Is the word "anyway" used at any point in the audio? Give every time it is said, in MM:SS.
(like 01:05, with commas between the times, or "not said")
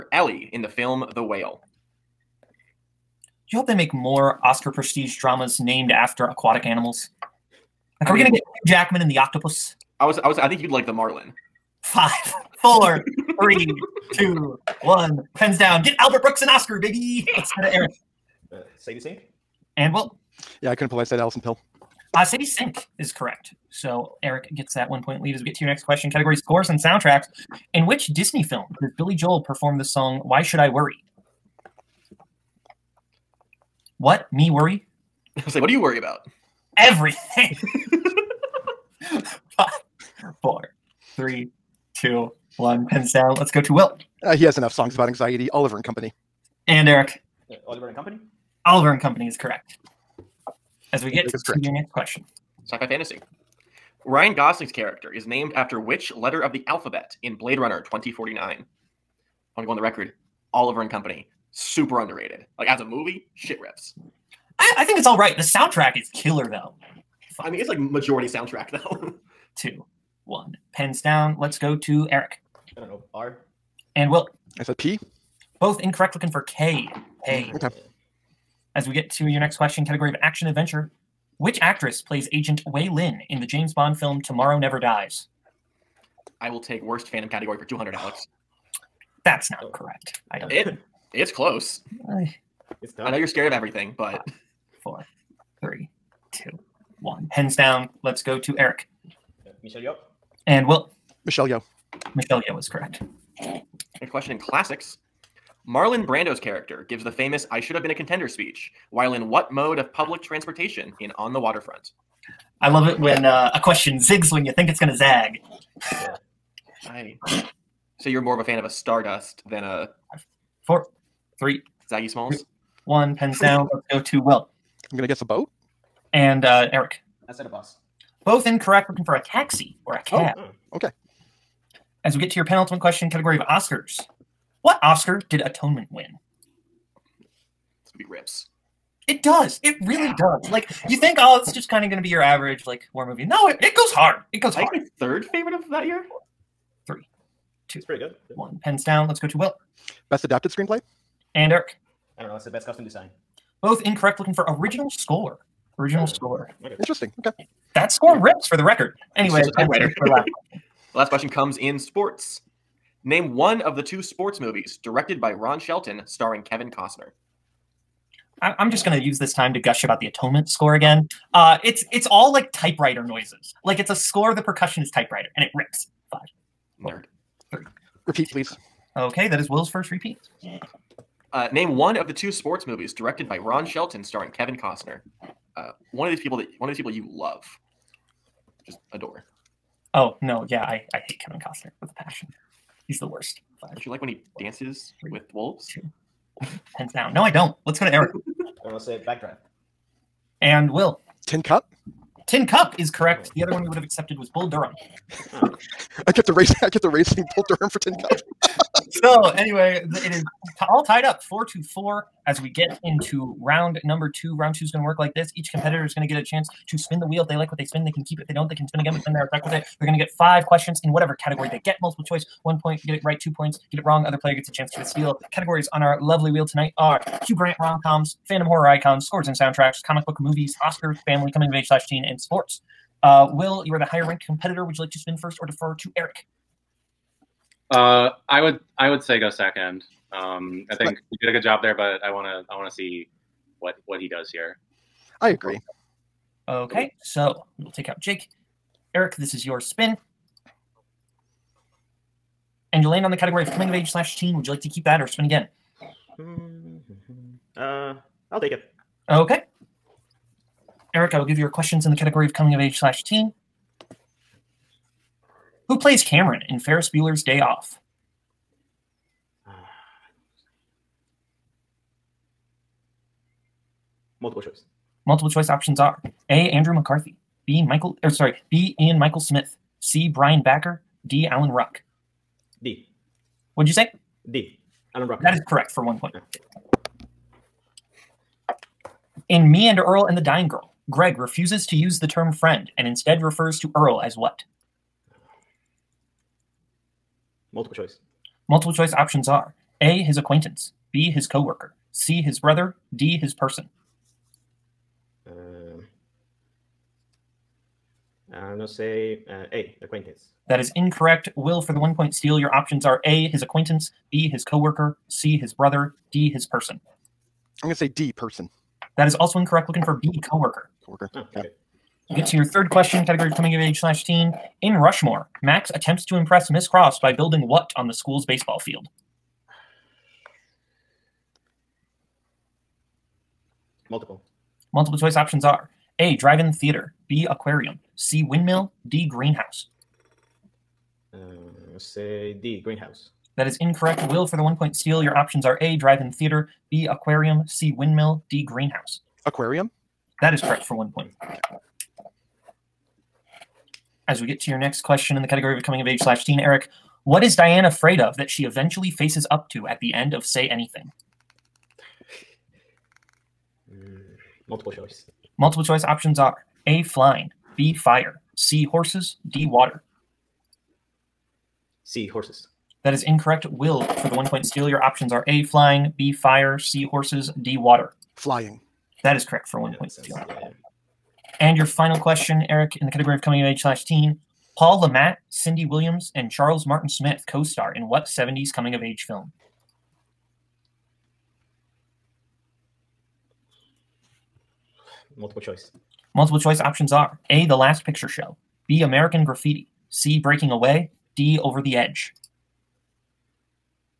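02:39, 03:29.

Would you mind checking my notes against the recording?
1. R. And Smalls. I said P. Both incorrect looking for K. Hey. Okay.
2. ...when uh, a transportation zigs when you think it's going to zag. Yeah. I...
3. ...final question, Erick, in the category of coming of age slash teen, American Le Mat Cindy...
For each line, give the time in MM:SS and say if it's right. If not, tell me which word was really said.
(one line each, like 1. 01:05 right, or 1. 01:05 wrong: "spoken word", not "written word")
1. 01:13 wrong: "Will", not "Smalls"
2. 01:52 wrong: "question", not "transportation"
3. 06:21 wrong: "Paul", not "American".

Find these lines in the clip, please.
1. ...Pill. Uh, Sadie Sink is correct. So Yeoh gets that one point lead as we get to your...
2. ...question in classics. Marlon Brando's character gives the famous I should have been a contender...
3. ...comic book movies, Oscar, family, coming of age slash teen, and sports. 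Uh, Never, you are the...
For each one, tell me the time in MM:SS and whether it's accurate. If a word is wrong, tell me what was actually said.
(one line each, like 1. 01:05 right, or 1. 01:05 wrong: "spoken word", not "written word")
1. 00:21 wrong: "Erick", not "Yeoh"
2. 01:44 right
3. 03:49 wrong: "Will", not "Never".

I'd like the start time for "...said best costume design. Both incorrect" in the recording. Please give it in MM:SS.
02:32.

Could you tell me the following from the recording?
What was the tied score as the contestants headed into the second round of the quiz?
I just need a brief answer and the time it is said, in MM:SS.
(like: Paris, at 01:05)
4 to 4, at 03:31.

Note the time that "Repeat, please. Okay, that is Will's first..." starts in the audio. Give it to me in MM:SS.
02:58.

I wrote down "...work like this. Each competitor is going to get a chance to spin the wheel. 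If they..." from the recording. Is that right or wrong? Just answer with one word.
right.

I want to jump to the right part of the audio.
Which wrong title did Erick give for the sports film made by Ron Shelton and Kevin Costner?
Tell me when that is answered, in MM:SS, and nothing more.
03:19.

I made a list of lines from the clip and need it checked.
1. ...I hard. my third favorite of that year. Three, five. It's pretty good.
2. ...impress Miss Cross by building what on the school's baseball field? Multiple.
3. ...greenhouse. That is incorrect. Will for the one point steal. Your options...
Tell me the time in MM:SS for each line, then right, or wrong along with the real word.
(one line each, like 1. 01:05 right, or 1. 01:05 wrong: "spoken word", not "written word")
1. 02:24 wrong: "two", not "five"
2. 05:26 right
3. 05:42 right.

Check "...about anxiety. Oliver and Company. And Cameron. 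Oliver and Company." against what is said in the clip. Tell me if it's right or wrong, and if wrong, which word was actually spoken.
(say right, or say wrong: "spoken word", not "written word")
wrong: "Erick", not "Cameron".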